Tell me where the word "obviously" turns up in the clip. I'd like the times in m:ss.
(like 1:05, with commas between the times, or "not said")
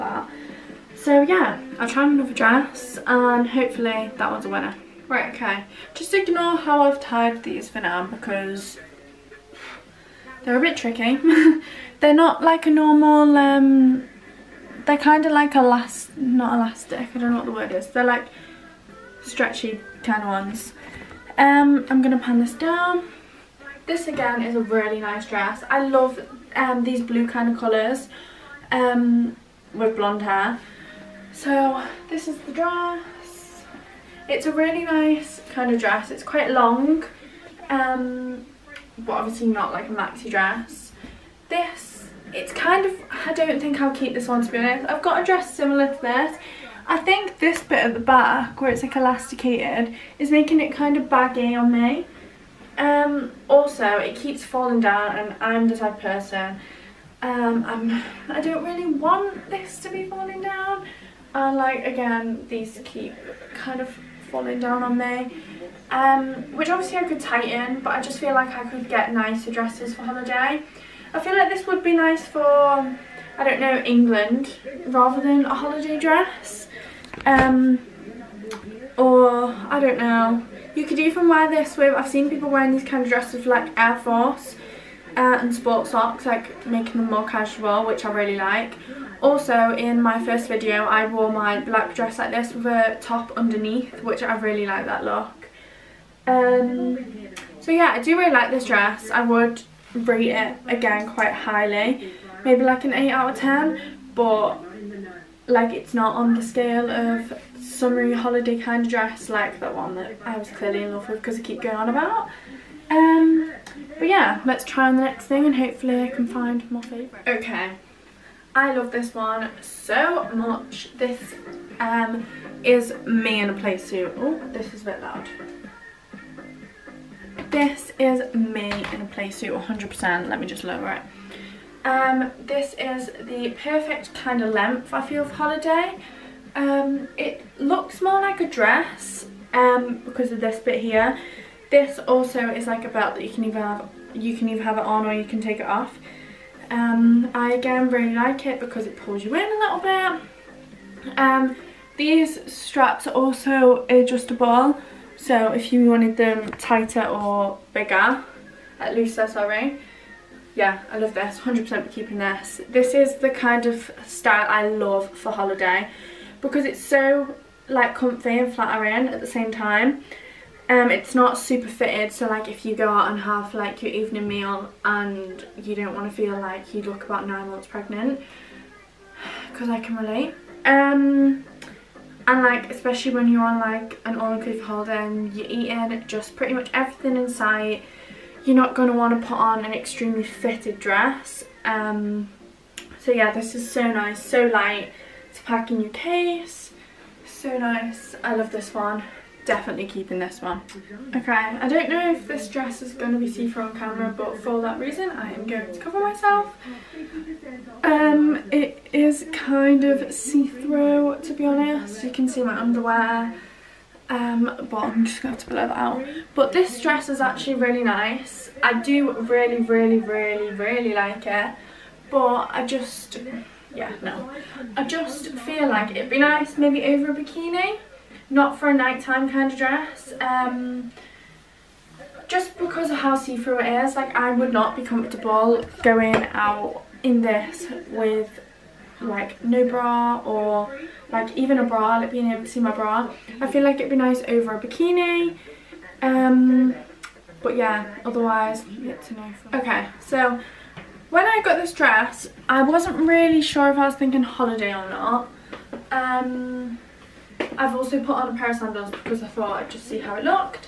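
0:39, 1:06.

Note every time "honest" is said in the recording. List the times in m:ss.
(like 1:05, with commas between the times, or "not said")
0:44, 3:31.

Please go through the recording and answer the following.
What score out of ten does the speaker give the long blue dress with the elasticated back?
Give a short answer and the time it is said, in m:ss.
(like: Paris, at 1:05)
8 out of 10, at 1:42.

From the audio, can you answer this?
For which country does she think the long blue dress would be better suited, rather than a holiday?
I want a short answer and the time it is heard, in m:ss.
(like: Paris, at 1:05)
England, at 1:13.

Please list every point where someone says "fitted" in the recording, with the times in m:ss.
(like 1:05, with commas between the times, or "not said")
2:51, 3:10.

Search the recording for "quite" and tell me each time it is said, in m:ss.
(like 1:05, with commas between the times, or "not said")
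0:36, 1:41.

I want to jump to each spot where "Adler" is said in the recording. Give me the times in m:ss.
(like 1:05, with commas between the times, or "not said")
not said.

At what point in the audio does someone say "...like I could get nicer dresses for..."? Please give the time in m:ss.
1:08.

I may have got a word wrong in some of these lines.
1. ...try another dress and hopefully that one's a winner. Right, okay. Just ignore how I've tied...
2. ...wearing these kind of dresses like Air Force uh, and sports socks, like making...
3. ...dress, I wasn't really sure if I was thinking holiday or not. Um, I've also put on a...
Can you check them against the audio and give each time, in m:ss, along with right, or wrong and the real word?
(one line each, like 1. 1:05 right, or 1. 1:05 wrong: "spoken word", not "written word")
1. 0:01 right
2. 1:22 right
3. 4:11 right.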